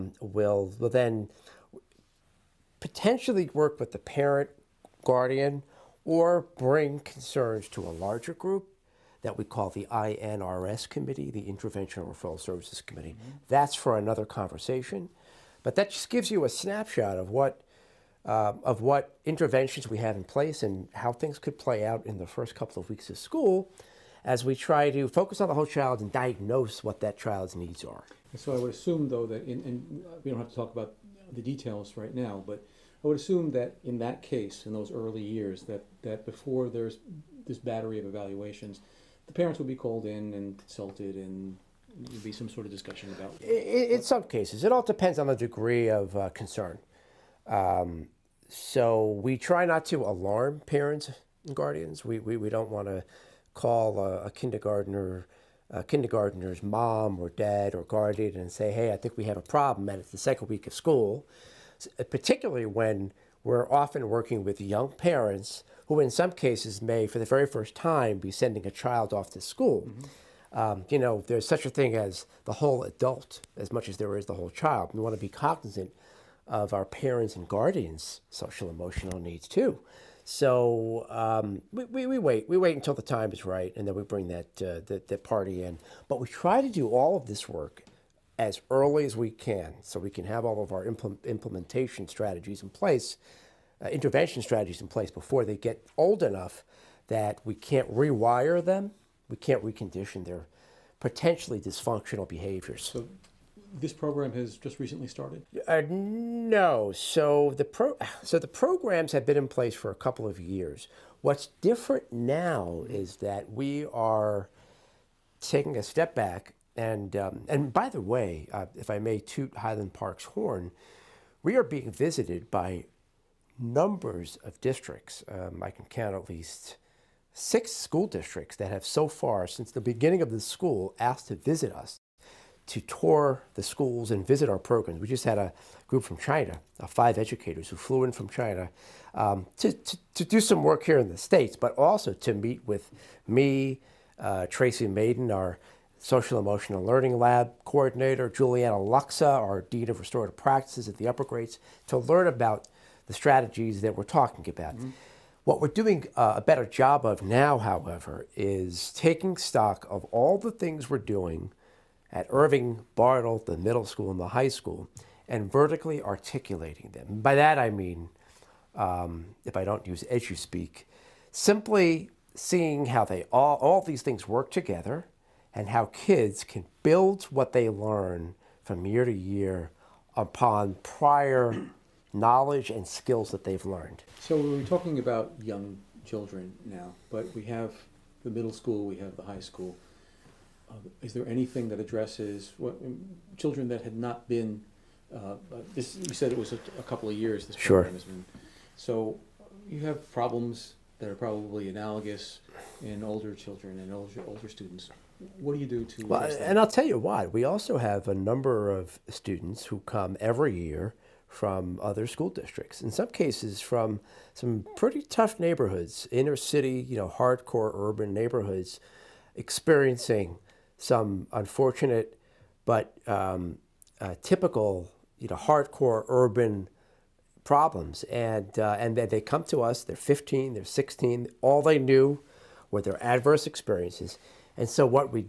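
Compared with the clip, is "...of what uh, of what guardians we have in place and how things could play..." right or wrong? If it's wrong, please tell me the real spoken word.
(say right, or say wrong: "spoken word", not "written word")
wrong: "interventions", not "guardians".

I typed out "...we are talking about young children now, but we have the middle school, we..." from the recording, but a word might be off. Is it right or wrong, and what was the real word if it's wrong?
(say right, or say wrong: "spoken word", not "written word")
right.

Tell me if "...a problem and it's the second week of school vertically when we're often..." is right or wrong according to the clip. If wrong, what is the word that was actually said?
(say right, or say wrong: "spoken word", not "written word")
wrong: "particularly", not "vertically".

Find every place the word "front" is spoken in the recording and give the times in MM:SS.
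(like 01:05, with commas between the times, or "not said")
not said.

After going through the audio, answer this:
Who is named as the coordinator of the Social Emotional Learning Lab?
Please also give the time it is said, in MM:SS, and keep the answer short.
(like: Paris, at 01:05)
Tracy Maiden, at 02:24.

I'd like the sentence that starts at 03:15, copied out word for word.
Uh, uh, this you said it was a, a couple of years.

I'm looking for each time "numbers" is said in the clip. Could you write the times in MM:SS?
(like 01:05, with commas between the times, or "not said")
02:03, 03:28.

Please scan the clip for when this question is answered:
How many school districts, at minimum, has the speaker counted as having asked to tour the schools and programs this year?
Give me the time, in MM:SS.
02:07.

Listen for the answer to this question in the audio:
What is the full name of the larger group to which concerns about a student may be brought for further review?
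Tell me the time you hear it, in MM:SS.
00:11.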